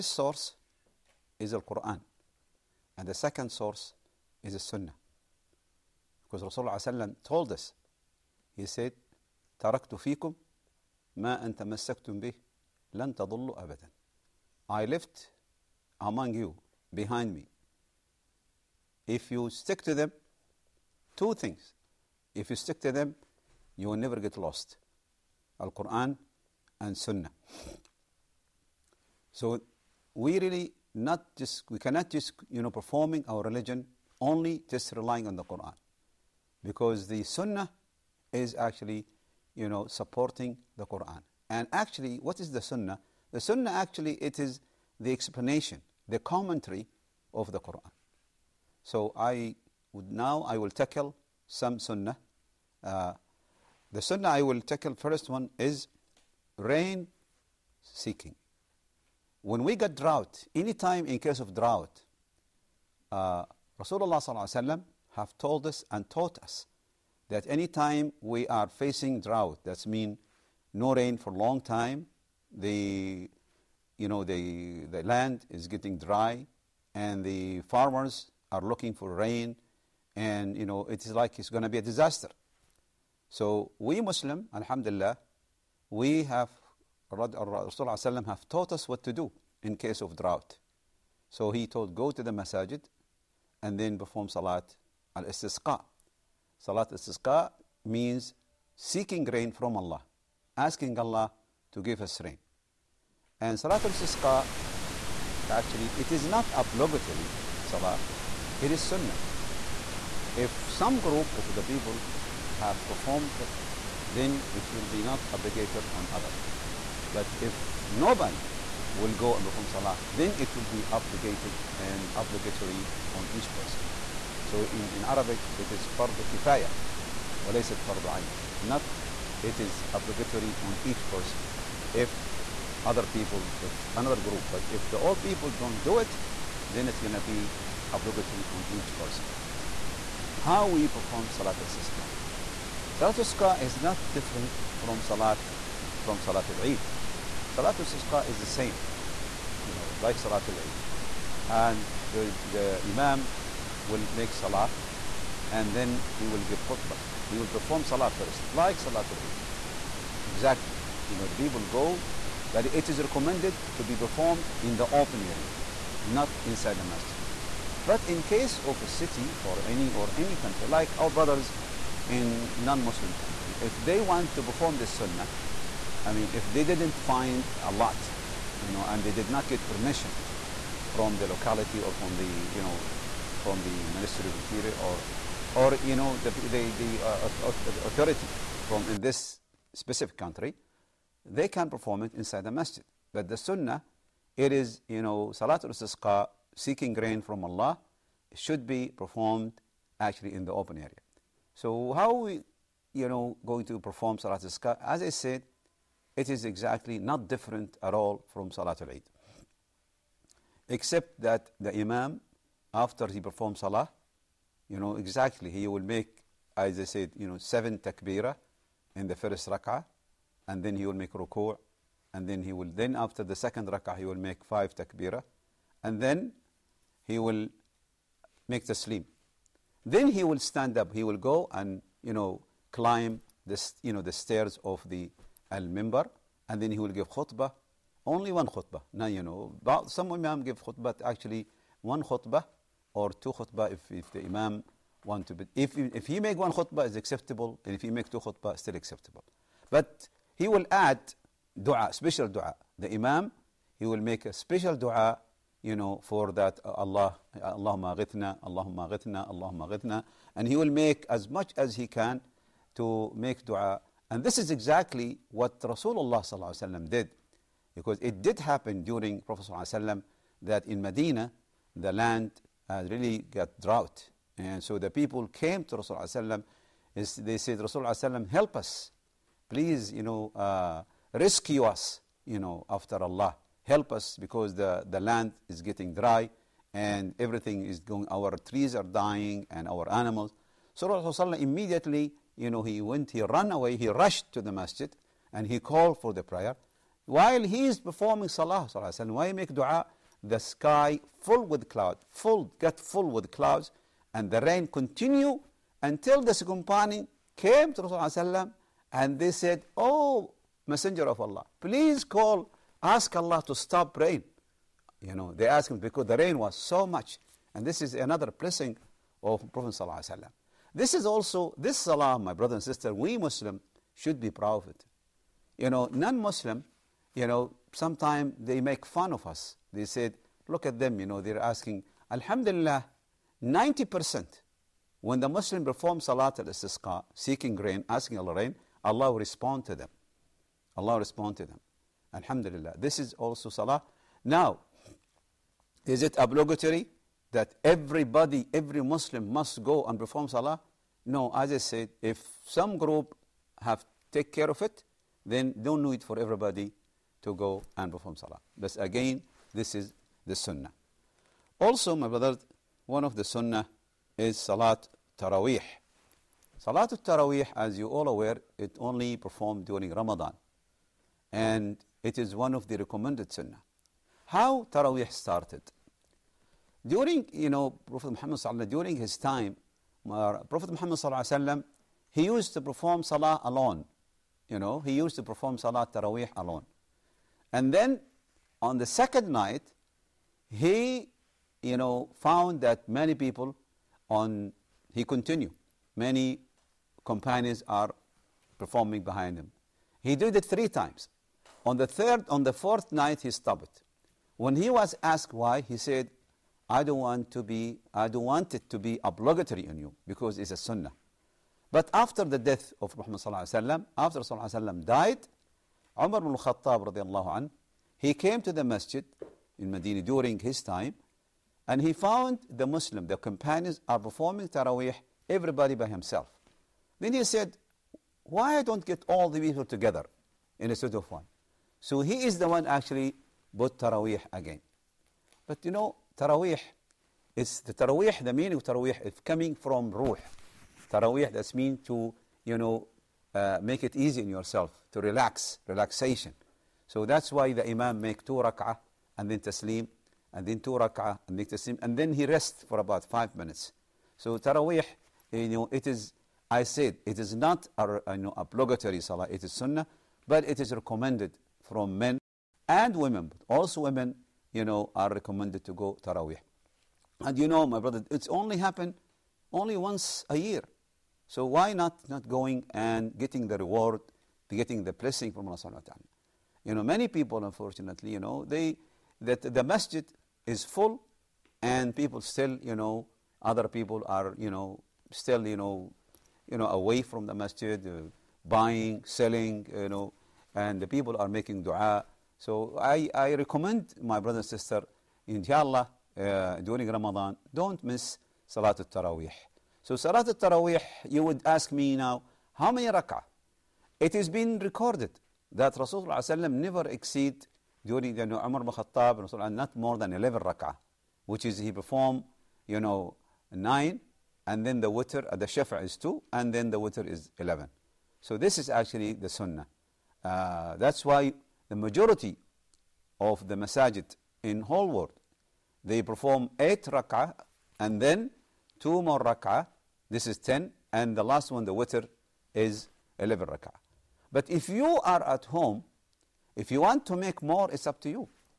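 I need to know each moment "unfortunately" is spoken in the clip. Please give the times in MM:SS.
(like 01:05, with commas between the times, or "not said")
07:57.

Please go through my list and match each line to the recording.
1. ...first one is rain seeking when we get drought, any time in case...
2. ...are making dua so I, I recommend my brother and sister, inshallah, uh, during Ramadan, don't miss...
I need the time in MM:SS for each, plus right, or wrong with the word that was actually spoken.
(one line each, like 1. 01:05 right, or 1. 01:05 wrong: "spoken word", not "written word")
1. 00:54 right
2. 08:11 right.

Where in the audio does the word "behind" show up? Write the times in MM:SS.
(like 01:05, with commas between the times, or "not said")
00:16, 06:39.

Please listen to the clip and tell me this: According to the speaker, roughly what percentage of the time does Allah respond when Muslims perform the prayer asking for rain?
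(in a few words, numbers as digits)
90%.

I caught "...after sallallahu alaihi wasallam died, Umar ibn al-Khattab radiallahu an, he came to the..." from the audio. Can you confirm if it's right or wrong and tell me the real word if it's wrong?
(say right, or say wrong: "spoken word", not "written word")
right.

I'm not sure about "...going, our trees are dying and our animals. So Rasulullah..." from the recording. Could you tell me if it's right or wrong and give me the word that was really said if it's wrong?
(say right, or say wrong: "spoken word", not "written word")
right.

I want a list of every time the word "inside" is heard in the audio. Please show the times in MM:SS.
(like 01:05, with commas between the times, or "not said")
02:46, 03:12.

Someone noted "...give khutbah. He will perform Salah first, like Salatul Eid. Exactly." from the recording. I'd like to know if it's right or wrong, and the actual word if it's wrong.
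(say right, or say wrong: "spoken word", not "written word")
right.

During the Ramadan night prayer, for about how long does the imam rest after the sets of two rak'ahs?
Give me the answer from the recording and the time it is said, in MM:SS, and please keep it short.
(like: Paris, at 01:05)
About 5 minutes, at 07:33.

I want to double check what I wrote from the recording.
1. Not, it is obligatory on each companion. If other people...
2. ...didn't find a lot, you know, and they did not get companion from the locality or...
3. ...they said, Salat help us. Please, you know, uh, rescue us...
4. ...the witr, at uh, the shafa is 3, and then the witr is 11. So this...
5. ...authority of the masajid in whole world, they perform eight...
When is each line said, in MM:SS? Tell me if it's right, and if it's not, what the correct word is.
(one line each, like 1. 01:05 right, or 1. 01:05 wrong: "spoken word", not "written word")
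1. 02:08 wrong: "person", not "companion"
2. 02:56 wrong: "permission", not "companion"
3. 04:36 wrong: "Rasulullah", not "Salat"
4. 08:34 wrong: "2", not "3"
5. 08:41 wrong: "majority", not "authority".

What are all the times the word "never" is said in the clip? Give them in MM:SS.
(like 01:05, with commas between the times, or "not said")
00:23, 08:26.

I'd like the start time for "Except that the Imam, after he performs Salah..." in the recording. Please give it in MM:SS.
03:30.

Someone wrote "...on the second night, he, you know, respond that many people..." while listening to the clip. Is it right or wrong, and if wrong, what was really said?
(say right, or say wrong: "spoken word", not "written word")
wrong: "found", not "respond".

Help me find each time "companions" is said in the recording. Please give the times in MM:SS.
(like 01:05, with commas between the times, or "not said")
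05:06, 06:37, 07:03.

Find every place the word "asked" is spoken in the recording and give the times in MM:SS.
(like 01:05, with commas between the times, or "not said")
05:15, 06:45.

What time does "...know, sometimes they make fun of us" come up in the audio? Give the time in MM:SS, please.
05:27.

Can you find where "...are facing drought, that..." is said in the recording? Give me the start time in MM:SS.
01:08.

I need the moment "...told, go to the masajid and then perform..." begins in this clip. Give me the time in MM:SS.
01:31.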